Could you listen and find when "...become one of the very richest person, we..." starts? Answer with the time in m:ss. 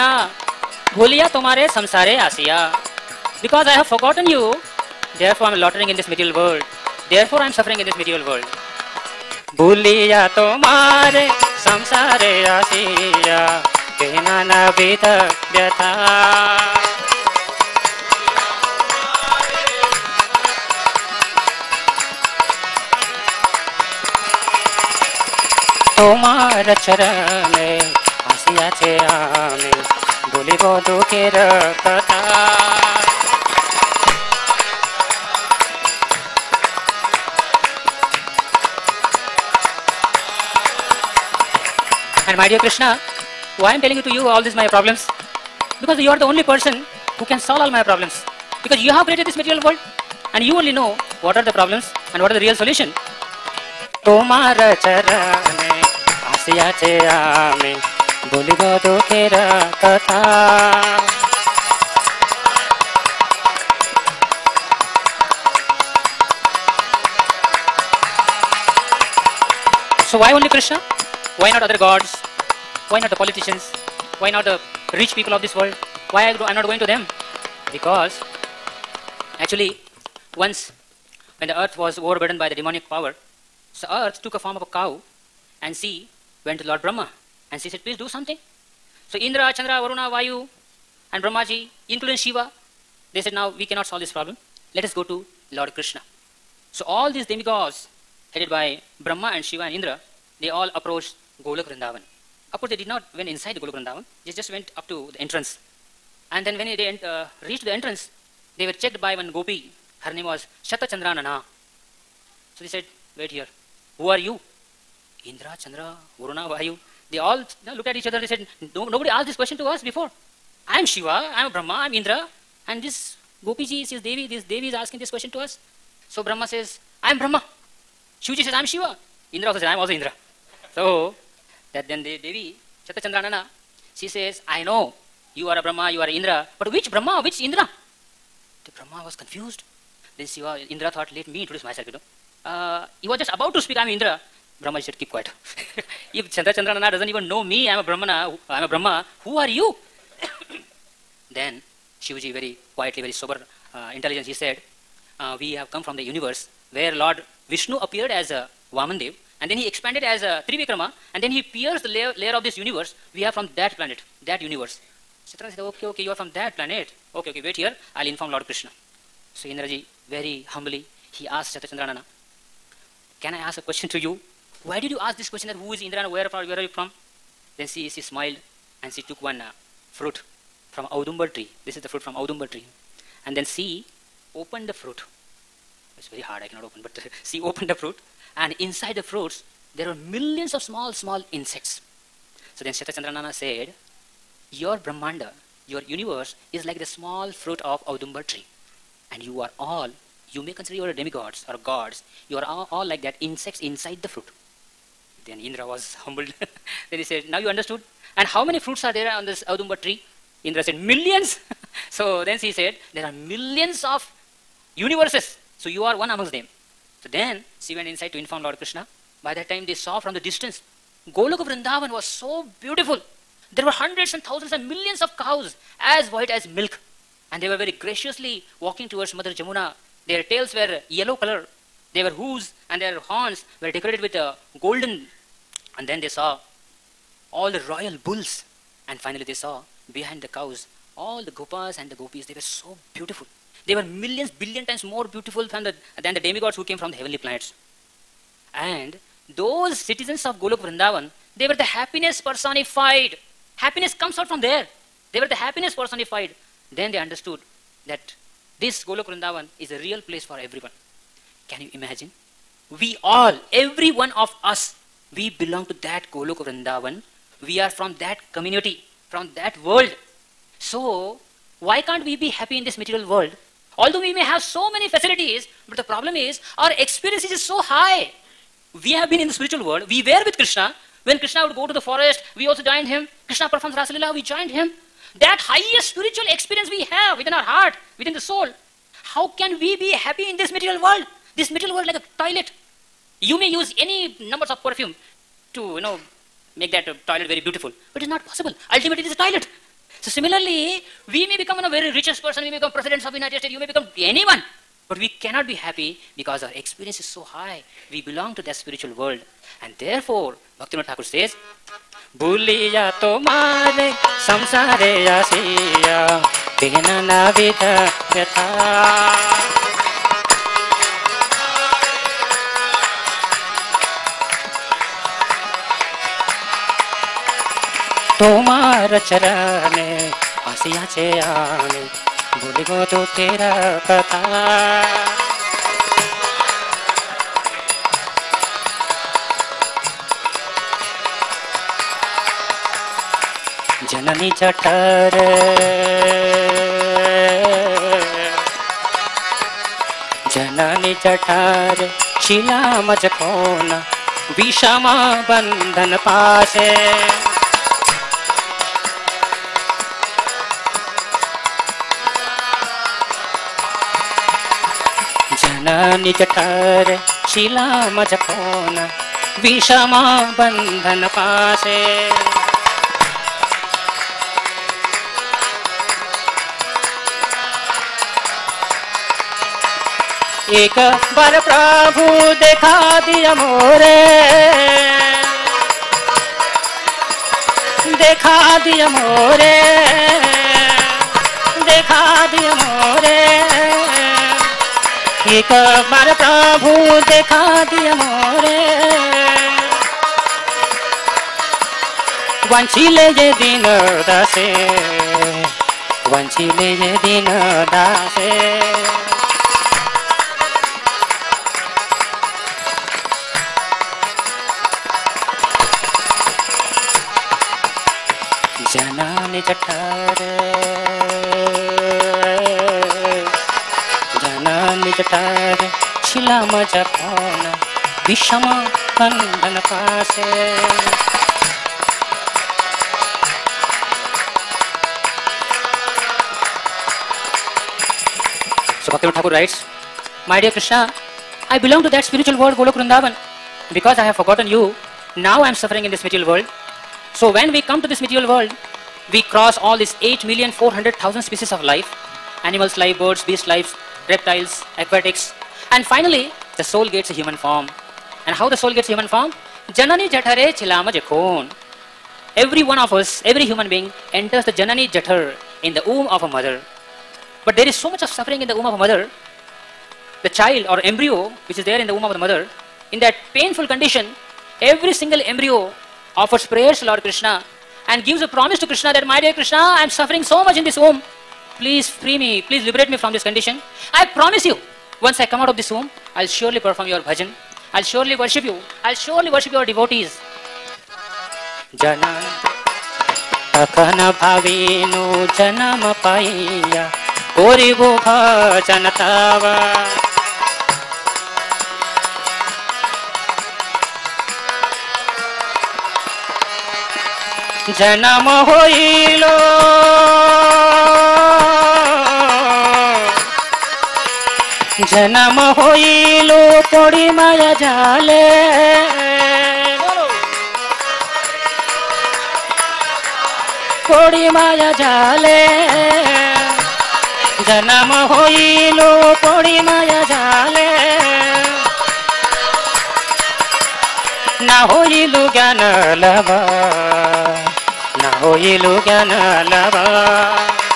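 5:01.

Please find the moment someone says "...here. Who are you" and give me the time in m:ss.
1:53.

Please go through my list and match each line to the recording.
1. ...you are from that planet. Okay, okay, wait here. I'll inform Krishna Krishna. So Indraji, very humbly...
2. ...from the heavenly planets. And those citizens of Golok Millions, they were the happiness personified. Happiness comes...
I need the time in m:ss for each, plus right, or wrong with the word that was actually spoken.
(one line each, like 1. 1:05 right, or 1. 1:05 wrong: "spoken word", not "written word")
1. 2:46 wrong: "Lord", not "Krishna"
2. 4:06 wrong: "Vrindavan", not "Millions".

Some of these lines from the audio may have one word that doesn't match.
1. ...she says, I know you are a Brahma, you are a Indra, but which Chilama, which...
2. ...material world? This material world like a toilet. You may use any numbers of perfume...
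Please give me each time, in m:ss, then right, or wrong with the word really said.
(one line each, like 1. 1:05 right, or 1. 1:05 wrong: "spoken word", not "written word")
1. 2:13 wrong: "Brahma", not "Chilama"
2. 4:50 right.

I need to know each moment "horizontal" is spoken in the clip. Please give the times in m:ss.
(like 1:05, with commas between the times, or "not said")
not said.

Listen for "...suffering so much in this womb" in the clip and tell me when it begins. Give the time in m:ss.
7:59.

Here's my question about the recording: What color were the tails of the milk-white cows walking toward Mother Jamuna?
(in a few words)
yellow.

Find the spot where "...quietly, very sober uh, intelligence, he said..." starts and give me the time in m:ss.
2:32.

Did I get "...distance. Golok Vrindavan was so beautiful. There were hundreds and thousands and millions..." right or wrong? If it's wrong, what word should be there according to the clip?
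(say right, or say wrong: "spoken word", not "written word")
right.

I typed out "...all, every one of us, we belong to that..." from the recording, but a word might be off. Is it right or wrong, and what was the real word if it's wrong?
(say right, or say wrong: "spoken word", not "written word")
right.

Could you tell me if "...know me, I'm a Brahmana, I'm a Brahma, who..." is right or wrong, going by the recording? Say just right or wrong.
right.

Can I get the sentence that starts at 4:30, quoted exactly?
So, why can't we be happy in this material world?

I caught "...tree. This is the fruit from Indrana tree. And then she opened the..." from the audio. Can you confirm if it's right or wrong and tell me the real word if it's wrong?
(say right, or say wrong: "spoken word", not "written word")
wrong: "Audumbar", not "Indrana".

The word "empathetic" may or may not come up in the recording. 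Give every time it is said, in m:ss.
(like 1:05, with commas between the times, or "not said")
not said.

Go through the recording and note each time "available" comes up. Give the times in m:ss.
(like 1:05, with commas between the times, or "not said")
not said.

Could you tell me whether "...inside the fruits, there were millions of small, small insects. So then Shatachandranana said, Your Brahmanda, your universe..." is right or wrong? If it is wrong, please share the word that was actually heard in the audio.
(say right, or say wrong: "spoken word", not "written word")
right.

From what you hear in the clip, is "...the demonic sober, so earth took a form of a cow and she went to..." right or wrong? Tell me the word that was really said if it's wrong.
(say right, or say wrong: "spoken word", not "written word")
wrong: "power", not "sober".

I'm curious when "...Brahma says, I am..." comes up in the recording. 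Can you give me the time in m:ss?
2:06.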